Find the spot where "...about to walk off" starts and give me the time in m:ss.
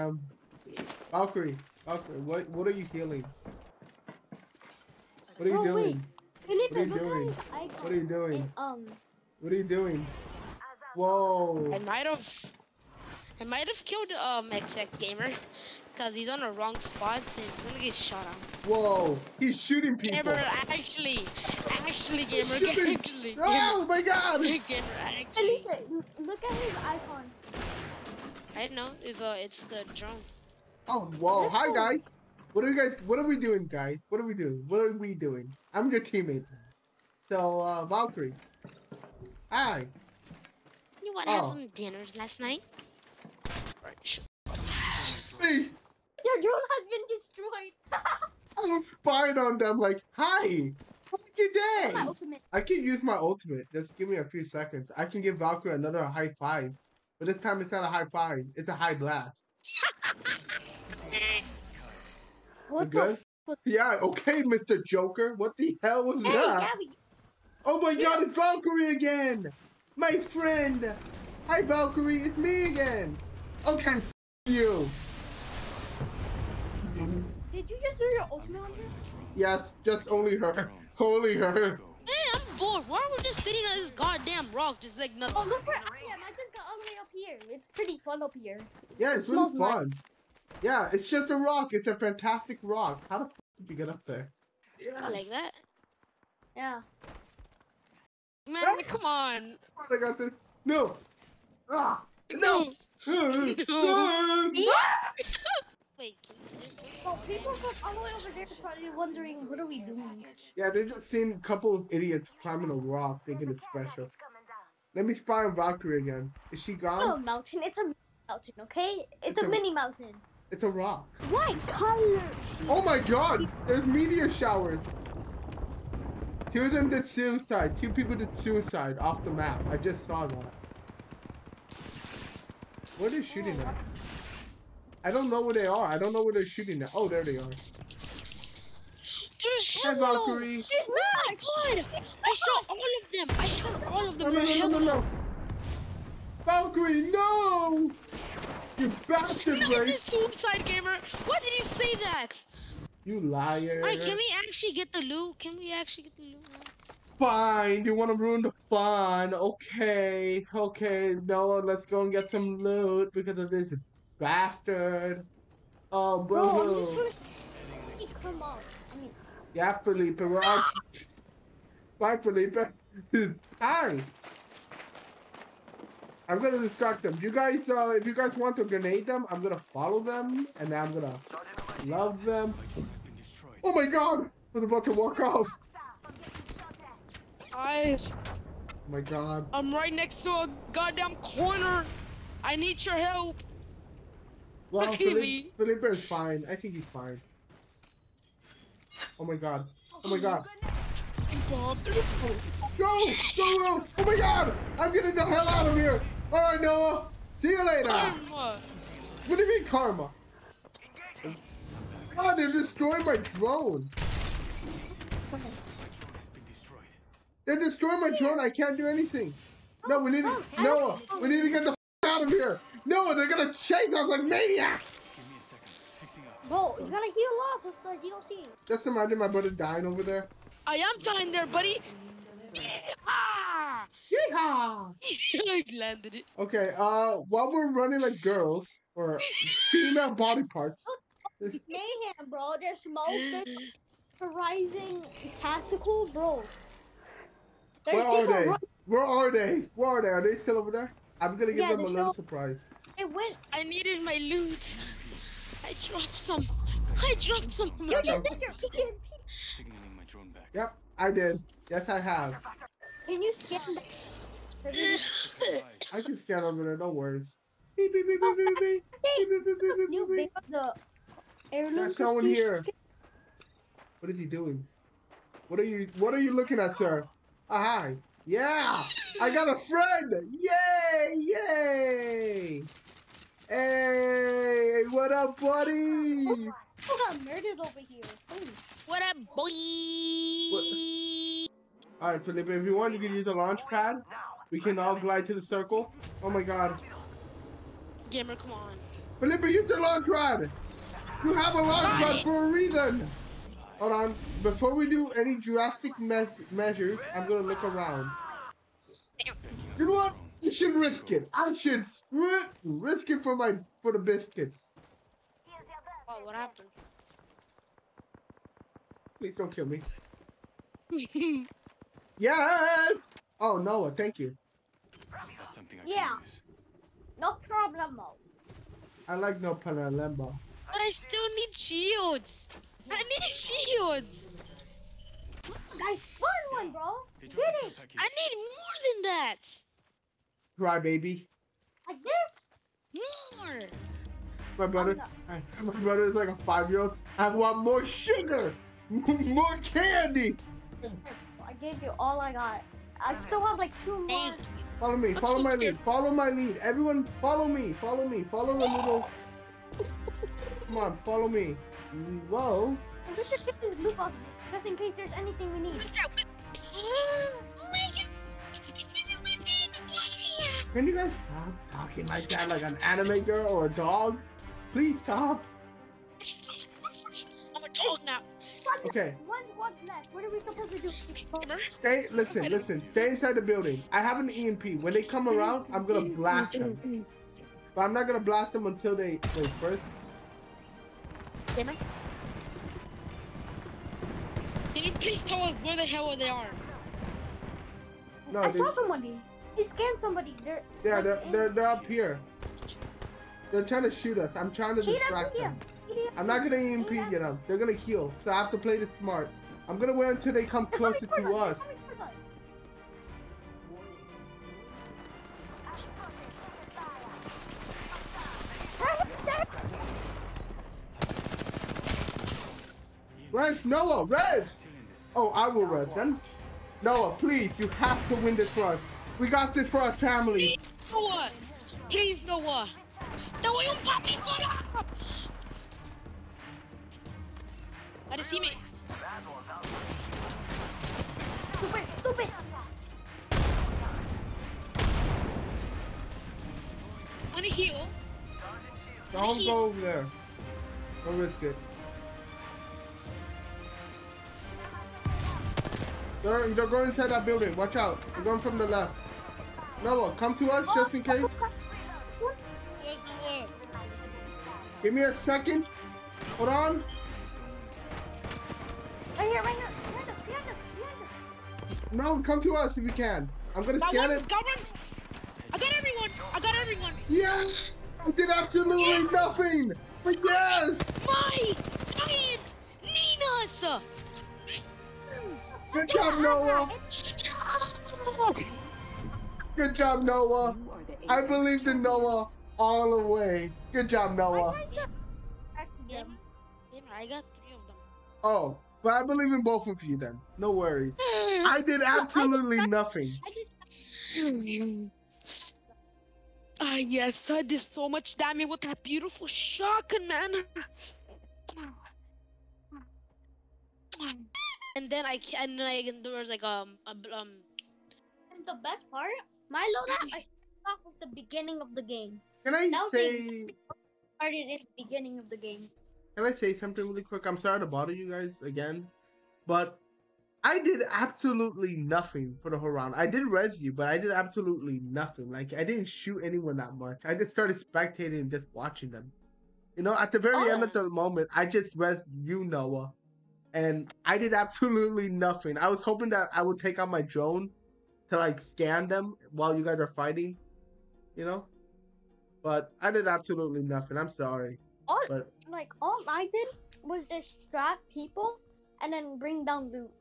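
3:04.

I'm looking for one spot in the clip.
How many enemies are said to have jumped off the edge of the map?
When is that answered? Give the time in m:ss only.
2:07.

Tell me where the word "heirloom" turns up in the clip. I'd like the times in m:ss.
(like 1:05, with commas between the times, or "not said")
4:31.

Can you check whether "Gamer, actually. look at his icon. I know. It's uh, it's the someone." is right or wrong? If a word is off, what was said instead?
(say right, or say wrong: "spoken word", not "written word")
wrong: "drone", not "someone".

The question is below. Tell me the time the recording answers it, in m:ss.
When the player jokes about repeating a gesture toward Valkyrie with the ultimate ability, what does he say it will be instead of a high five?
0:58.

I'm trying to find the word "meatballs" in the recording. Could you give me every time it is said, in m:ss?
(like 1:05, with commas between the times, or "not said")
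not said.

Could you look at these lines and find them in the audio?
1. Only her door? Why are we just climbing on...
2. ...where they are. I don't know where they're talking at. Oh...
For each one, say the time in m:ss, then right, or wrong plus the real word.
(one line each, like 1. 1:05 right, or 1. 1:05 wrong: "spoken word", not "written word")
1. 1:20 wrong: "sitting", not "climbing"
2. 2:15 wrong: "shooting", not "talking".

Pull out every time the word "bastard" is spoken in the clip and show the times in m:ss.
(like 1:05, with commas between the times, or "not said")
2:29, 2:44.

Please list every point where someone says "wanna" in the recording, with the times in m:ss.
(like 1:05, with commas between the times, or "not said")
0:41, 2:37.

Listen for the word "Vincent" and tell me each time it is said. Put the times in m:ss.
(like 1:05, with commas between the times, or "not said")
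not said.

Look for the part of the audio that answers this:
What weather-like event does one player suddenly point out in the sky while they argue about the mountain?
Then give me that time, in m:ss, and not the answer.
2:03.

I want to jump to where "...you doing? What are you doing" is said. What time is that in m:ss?
0:06.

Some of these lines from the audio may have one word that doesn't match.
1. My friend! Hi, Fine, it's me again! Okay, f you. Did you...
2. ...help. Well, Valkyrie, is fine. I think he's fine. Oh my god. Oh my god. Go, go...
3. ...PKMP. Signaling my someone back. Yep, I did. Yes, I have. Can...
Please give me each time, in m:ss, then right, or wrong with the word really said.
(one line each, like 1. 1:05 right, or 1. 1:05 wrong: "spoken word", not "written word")
1. 1:09 wrong: "Valkyrie", not "Fine"
2. 3:12 wrong: "Felipe", not "Valkyrie"
3. 4:18 wrong: "drone", not "someone".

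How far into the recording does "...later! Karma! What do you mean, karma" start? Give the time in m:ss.
3:27.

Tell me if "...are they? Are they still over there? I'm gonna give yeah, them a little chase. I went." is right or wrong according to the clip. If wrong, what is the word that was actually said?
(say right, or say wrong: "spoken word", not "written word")
wrong: "surprise", not "chase".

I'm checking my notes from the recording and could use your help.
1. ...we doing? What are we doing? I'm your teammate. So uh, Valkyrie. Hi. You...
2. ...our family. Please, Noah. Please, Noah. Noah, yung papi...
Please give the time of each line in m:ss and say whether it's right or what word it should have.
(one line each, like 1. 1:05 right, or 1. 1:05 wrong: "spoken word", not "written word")
1. 0:34 right
2. 7:09 right.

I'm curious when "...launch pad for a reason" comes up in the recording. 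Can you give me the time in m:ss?
5:01.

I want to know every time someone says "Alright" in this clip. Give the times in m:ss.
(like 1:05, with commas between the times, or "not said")
2:33, 3:26.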